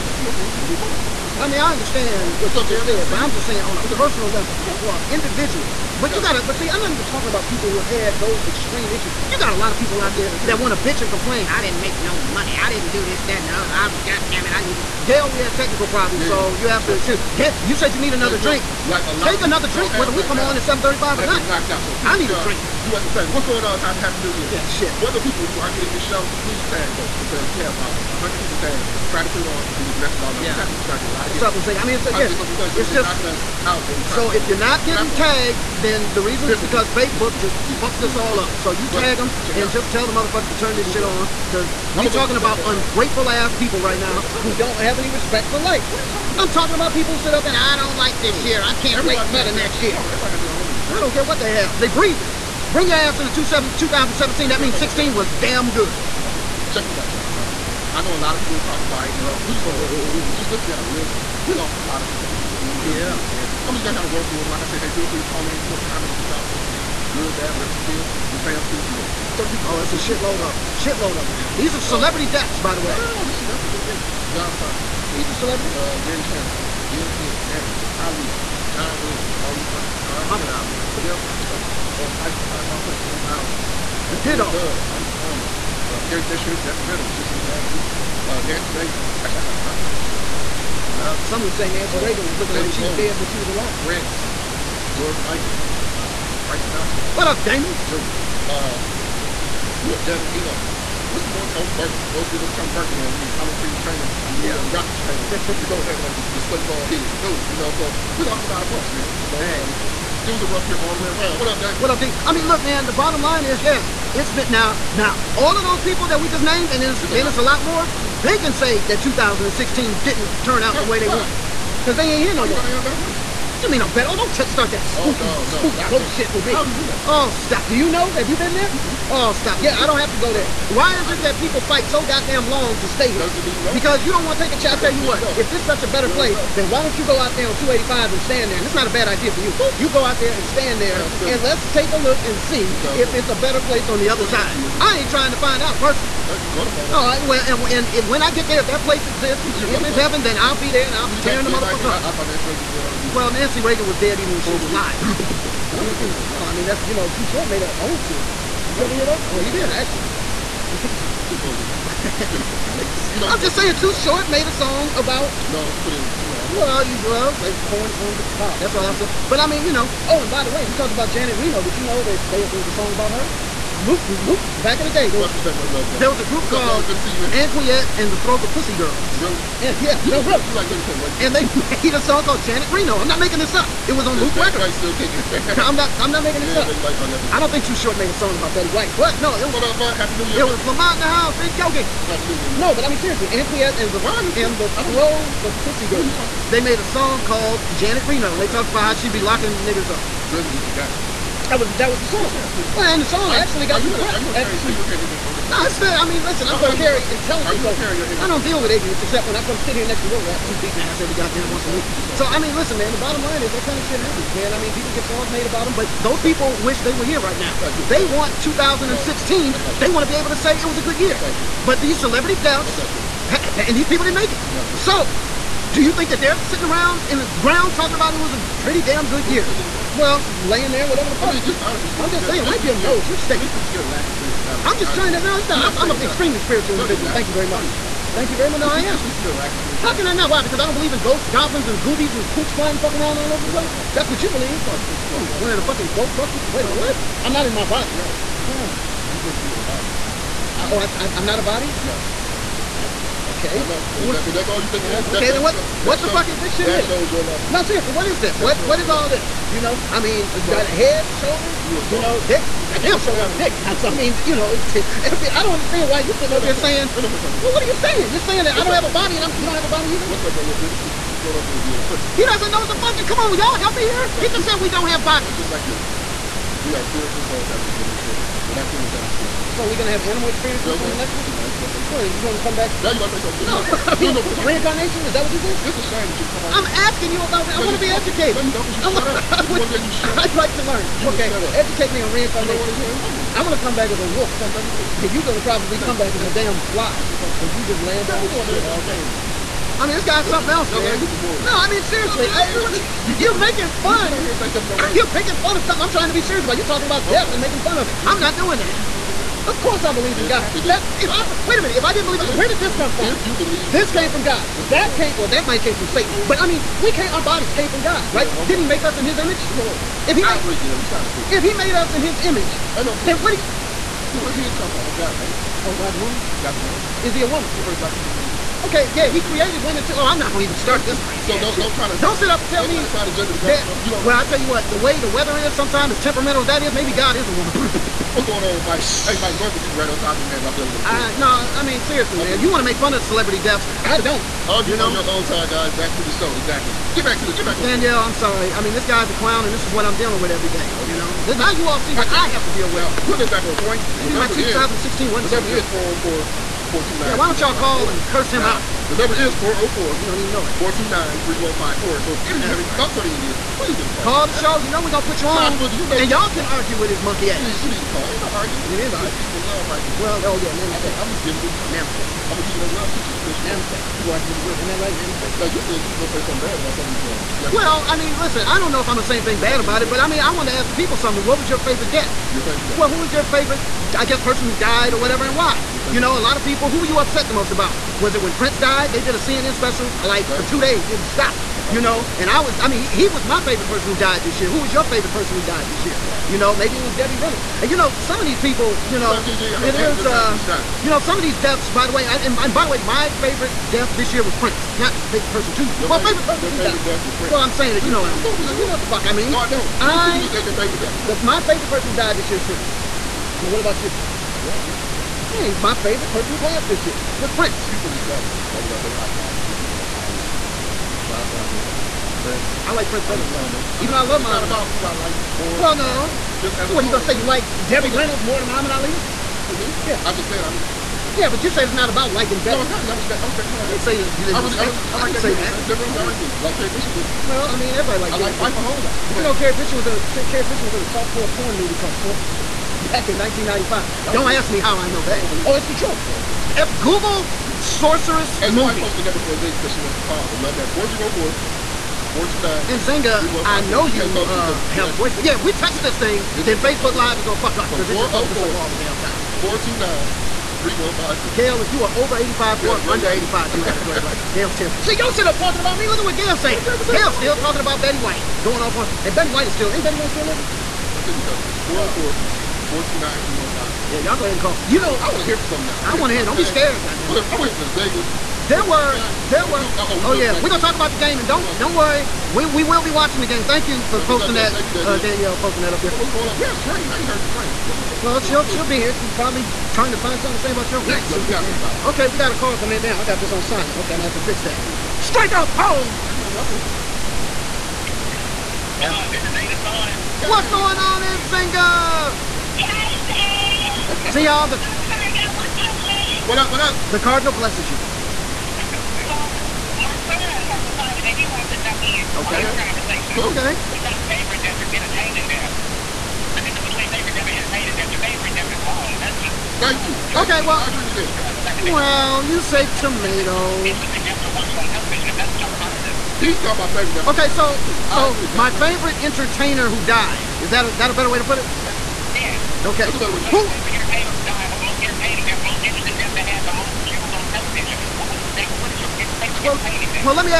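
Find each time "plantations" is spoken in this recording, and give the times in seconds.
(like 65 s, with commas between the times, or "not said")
not said.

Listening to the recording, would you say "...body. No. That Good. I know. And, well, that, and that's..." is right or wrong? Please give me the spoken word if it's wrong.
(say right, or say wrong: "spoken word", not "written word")
wrong: "Okay", not "Good".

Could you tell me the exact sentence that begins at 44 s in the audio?
don't have any respect for life.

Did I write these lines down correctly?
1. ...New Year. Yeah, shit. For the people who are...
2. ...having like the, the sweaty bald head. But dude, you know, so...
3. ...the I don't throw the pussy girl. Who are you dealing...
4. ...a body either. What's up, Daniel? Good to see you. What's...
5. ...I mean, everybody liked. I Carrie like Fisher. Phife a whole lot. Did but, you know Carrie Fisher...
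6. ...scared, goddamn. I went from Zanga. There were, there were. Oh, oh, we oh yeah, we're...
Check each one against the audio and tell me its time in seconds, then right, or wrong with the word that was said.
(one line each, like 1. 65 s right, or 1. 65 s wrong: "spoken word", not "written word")
1. 24 s right
2. 105 s right
3. 194 s wrong: "talking", not "dealing"
4. 269 s right
5. 437 s right
6. 476 s right.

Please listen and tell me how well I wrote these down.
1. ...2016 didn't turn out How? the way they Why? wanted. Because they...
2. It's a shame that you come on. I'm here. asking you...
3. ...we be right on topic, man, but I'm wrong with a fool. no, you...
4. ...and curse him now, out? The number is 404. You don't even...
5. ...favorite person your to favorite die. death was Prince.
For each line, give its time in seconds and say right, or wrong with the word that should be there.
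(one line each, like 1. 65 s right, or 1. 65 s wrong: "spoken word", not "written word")
1. 118 s right
2. 285 s right
3. 339 s wrong: "dealing", not "wrong"
4. 357 s right
5. 406 s right.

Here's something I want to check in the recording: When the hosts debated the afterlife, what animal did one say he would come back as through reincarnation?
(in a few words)
wolf.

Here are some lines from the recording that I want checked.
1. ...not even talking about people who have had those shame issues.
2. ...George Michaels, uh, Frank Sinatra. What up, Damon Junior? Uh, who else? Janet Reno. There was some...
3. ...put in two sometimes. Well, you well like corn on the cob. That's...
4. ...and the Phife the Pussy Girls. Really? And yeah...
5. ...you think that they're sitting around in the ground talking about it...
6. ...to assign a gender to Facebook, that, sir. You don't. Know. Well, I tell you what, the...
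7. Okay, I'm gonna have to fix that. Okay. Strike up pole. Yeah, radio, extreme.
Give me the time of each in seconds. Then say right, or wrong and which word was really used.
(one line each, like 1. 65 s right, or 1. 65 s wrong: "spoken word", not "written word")
1. 6 s wrong: "extreme", not "shame"
2. 94 s right
3. 165 s wrong: "lines", not "sometimes"
4. 177 s wrong: "Throw", not "Phife"
5. 225 s right
6. 332 s wrong: "God", not "Facebook"
7. 493 s wrong: "welcome", not "extreme".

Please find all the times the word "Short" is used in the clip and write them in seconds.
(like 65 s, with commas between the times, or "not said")
157 s, 163 s, 187 s.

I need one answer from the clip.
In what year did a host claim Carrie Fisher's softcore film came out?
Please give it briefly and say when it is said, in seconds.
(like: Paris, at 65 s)
1995, at 443 s.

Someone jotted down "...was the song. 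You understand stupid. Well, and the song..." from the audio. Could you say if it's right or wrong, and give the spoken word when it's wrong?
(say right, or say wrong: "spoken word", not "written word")
wrong: "sound", not "understand".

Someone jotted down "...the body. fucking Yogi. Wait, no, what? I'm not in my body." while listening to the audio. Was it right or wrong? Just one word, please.
wrong.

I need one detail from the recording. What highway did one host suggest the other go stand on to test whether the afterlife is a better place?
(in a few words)
285.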